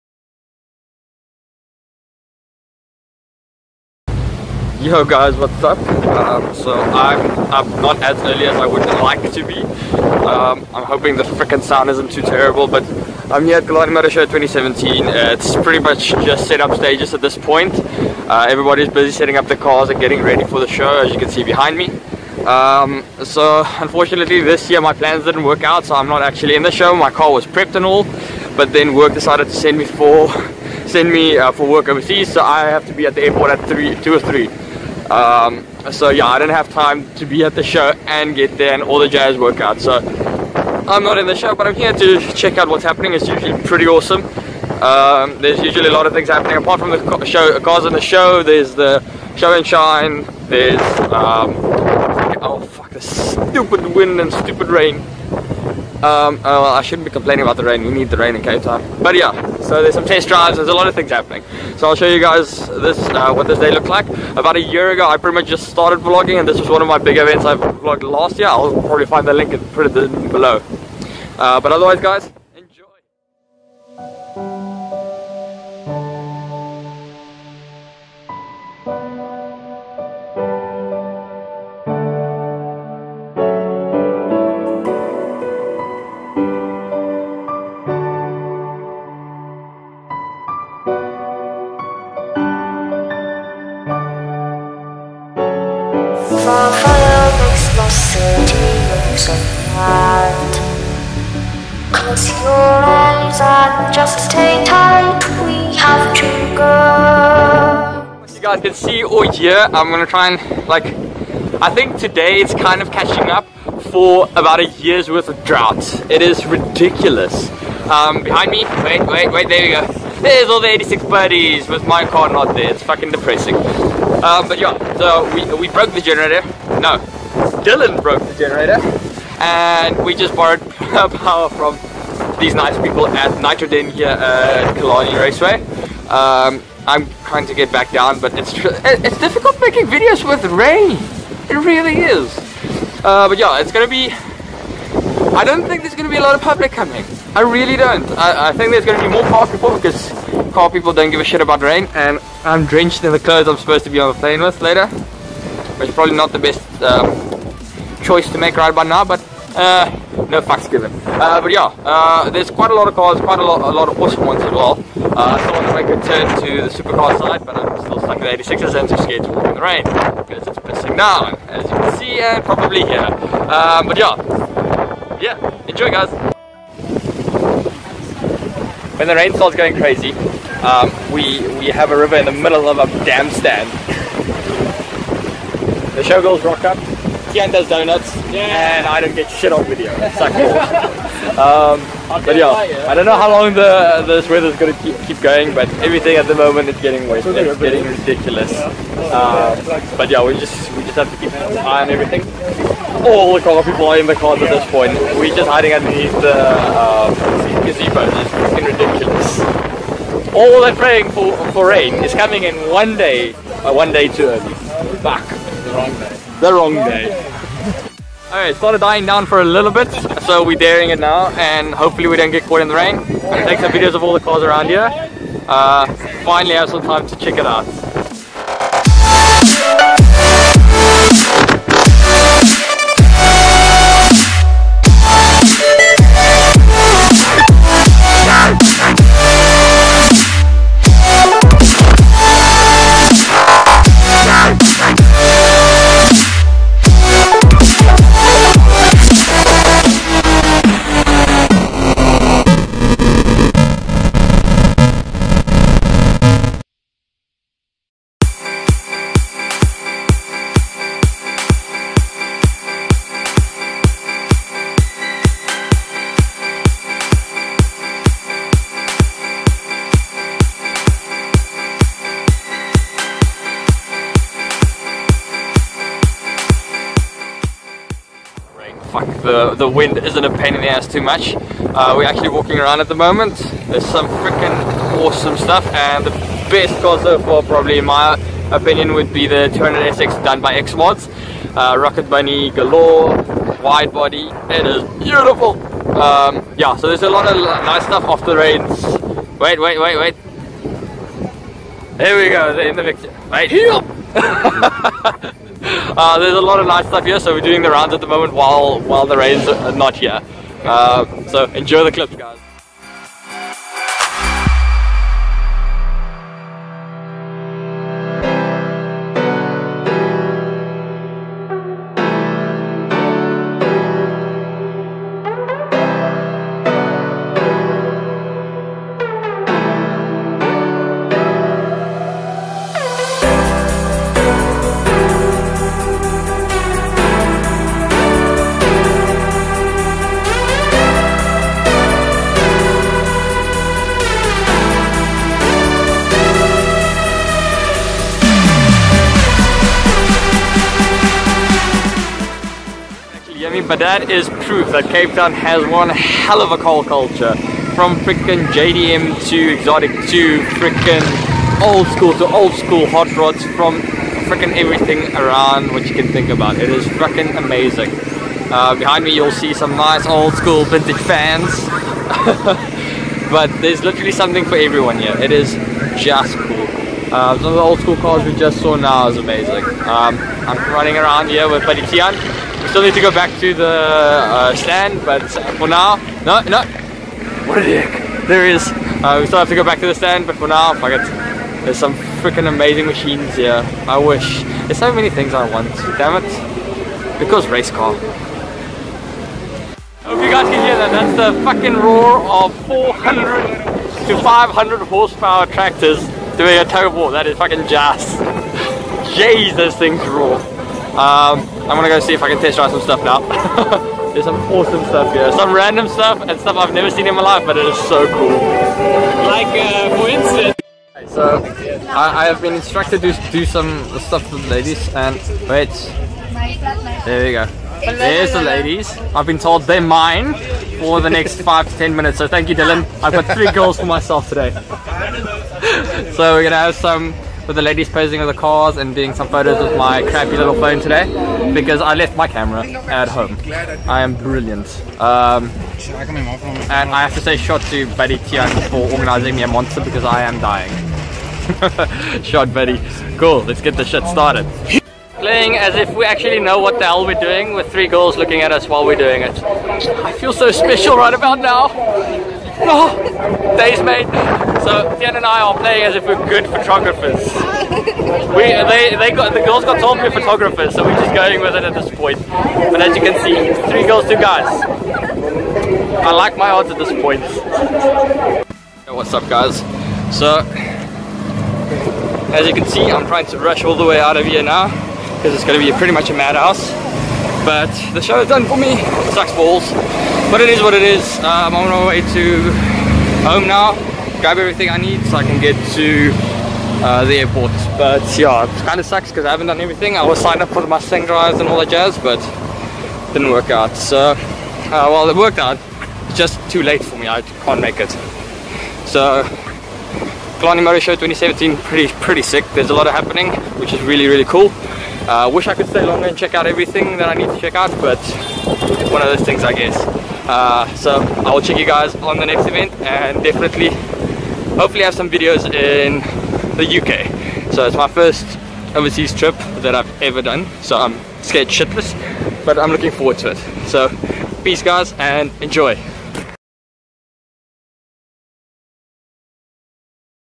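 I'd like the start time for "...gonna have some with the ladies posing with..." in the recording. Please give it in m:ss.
7:16.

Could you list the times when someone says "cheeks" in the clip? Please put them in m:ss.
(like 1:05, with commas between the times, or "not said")
not said.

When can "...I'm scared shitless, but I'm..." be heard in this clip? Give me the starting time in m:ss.
8:50.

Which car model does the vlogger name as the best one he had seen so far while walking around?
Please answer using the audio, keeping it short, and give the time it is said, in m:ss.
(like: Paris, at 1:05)
200SX, at 4:49.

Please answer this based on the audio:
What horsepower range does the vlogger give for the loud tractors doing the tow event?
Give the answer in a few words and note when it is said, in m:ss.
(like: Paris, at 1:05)
400 to 500, at 6:42.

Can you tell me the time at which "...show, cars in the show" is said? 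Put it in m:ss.
0:47.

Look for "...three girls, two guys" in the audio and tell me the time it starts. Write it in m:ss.
7:53.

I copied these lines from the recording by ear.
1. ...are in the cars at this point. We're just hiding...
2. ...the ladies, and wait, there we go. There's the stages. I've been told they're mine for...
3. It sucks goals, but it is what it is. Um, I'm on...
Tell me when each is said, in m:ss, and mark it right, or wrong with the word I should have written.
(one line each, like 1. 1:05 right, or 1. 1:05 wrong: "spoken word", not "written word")
1. 3:23 right
2. 7:04 wrong: "ladies", not "stages"
3. 8:08 wrong: "balls", not "goals".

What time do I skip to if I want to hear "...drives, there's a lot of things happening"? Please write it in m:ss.
1:00.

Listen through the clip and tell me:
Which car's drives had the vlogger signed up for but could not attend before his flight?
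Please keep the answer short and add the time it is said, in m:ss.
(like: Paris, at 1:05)
Mustang, at 8:20.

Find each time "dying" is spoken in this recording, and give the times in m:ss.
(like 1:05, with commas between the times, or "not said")
3:38, 7:30.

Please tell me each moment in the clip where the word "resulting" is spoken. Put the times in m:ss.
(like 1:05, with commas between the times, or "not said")
not said.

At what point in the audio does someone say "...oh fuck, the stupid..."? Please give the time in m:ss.
0:52.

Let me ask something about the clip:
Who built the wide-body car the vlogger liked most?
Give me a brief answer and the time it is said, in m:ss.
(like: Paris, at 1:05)
Xmods, at 4:50.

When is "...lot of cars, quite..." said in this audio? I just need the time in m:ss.
2:42.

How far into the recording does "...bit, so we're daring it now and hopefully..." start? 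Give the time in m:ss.
3:39.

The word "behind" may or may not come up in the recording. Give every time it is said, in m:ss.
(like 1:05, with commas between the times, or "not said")
0:21, 1:58, 6:08.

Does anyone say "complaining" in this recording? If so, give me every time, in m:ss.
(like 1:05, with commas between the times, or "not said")
0:57.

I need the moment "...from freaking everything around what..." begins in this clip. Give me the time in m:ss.
6:03.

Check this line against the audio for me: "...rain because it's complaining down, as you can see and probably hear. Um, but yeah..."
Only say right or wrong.
wrong.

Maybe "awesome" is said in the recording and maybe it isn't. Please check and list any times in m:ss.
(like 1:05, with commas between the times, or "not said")
0:43, 2:44, 4:44, 6:54.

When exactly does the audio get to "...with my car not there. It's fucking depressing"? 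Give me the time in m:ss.
2:01.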